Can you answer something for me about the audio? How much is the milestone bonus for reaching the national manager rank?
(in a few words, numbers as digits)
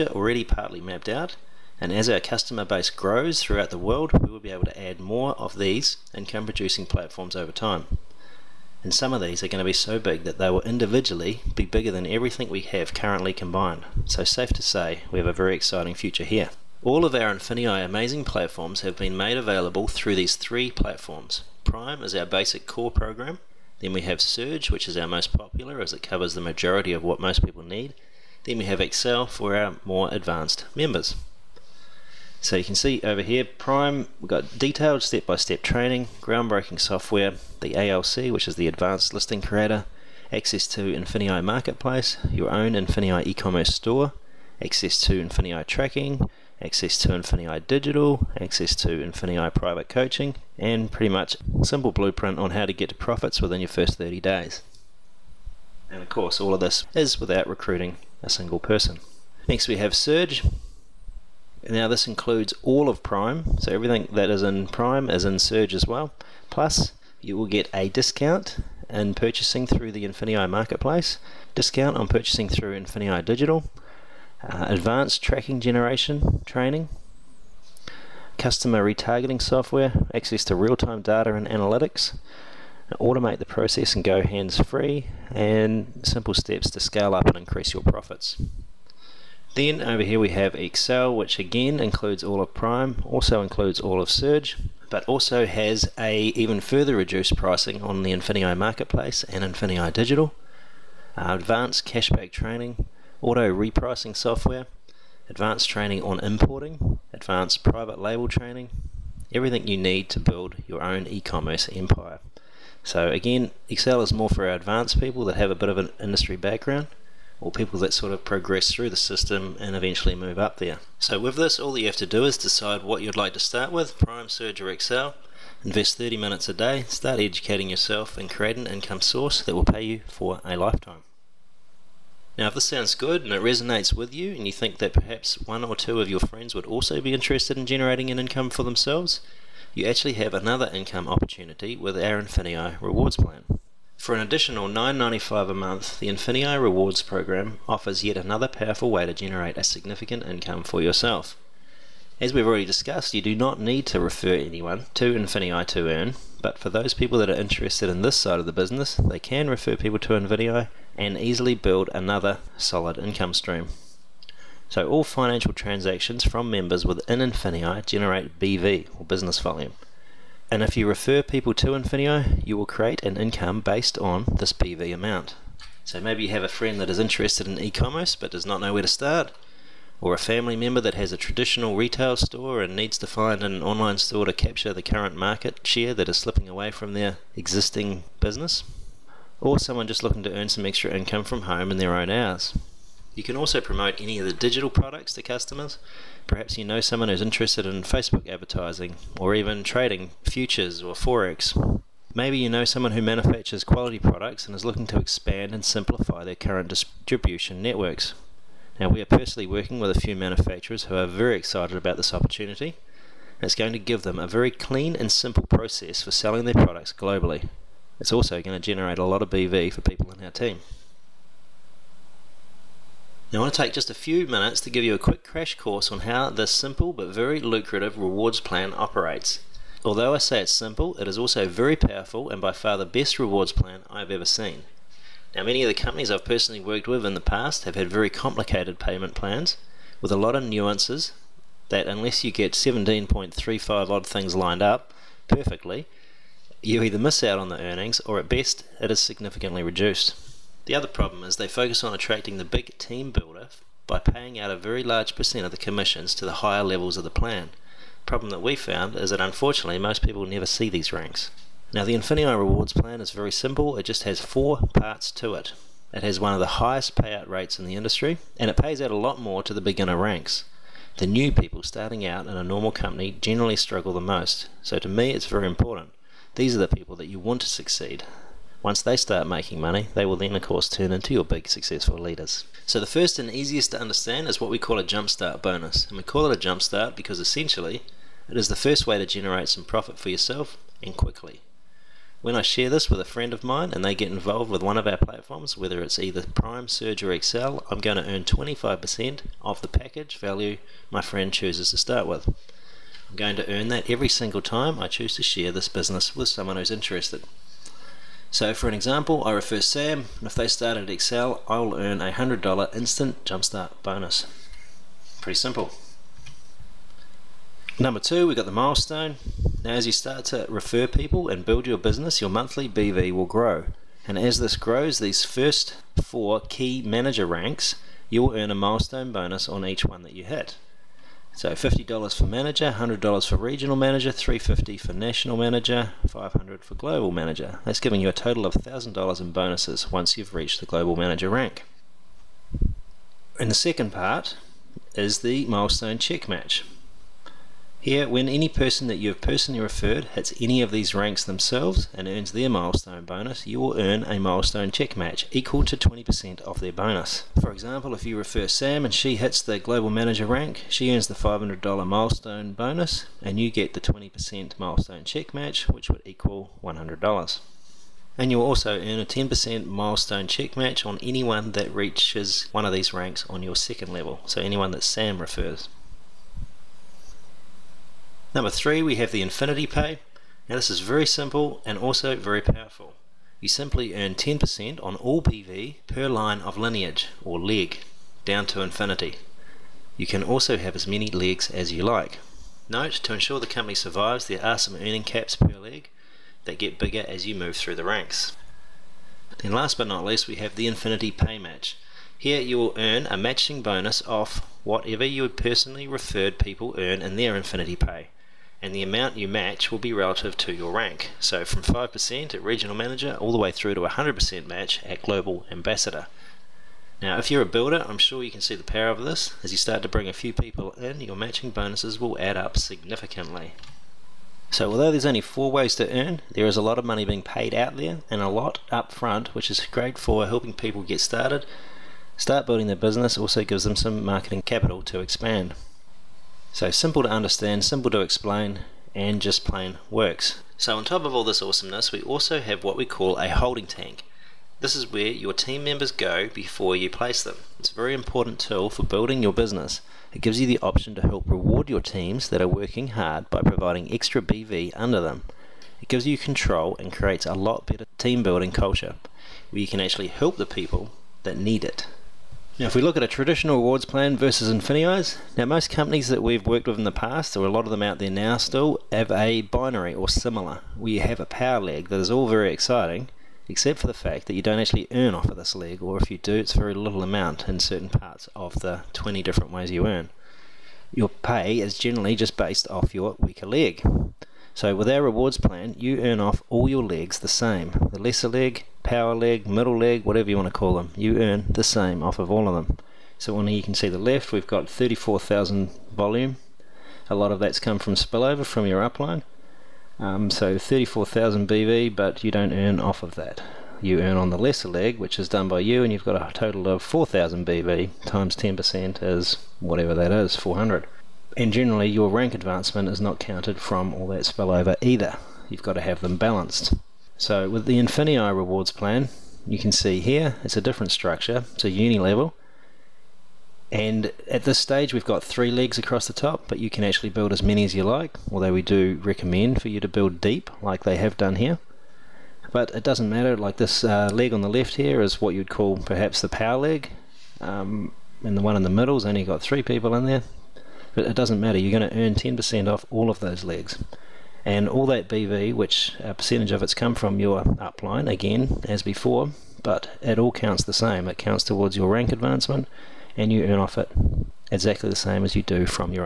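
$350.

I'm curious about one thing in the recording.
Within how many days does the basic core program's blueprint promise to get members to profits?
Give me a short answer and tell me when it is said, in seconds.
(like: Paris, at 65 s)
30 days, at 53 s.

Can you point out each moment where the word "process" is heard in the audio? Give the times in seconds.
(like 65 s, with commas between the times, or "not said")
83 s, 215 s.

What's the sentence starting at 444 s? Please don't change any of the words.
This is where your team members go before you place them.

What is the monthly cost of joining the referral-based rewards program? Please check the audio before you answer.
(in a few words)
$9.95.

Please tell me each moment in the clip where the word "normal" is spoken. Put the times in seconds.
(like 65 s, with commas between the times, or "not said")
272 s.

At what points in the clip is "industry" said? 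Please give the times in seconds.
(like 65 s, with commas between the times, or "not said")
115 s, 267 s.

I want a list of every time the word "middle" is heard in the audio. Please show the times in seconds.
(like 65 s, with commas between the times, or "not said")
489 s, 538 s.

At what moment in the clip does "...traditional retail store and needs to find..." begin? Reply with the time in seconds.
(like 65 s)
181 s.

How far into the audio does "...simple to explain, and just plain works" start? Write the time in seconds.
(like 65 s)
437 s.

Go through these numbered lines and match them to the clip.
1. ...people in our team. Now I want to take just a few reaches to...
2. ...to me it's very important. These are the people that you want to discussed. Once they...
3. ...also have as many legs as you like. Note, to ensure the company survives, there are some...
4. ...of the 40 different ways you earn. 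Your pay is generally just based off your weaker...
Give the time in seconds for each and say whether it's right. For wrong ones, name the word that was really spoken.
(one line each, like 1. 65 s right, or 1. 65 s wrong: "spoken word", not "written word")
1. 219 s wrong: "minutes", not "reaches"
2. 274 s wrong: "succeed", not "discussed"
3. 390 s right
4. 478 s wrong: "20", not "40".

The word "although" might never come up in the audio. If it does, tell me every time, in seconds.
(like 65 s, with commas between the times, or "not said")
229 s, 424 s, 528 s.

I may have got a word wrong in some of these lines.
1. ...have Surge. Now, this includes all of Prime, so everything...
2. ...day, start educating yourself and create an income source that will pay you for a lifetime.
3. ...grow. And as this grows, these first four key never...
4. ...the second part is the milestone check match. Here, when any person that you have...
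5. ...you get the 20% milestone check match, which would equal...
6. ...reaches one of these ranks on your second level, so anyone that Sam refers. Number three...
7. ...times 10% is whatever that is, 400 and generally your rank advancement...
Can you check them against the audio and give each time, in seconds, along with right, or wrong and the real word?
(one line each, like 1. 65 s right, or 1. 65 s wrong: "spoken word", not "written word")
1. 59 s right
2. 126 s right
3. 323 s wrong: "manager", not "never"
4. 343 s right
5. 363 s right
6. 371 s right
7. 508 s right.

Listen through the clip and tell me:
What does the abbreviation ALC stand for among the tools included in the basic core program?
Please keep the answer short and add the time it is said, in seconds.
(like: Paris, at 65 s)
Advanced Listing Creator, at 38 s.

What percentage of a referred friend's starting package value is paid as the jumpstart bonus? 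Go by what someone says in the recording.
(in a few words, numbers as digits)
25%.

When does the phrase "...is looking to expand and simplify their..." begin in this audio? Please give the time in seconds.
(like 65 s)
204 s.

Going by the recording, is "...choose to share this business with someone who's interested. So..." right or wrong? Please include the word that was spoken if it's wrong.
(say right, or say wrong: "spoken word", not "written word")
right.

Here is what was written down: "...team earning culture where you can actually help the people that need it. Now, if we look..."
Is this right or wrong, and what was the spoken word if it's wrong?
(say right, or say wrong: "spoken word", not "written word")
wrong: "building", not "earning".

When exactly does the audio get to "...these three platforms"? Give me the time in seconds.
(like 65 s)
20 s.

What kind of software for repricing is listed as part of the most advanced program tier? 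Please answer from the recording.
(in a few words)
auto repricing software.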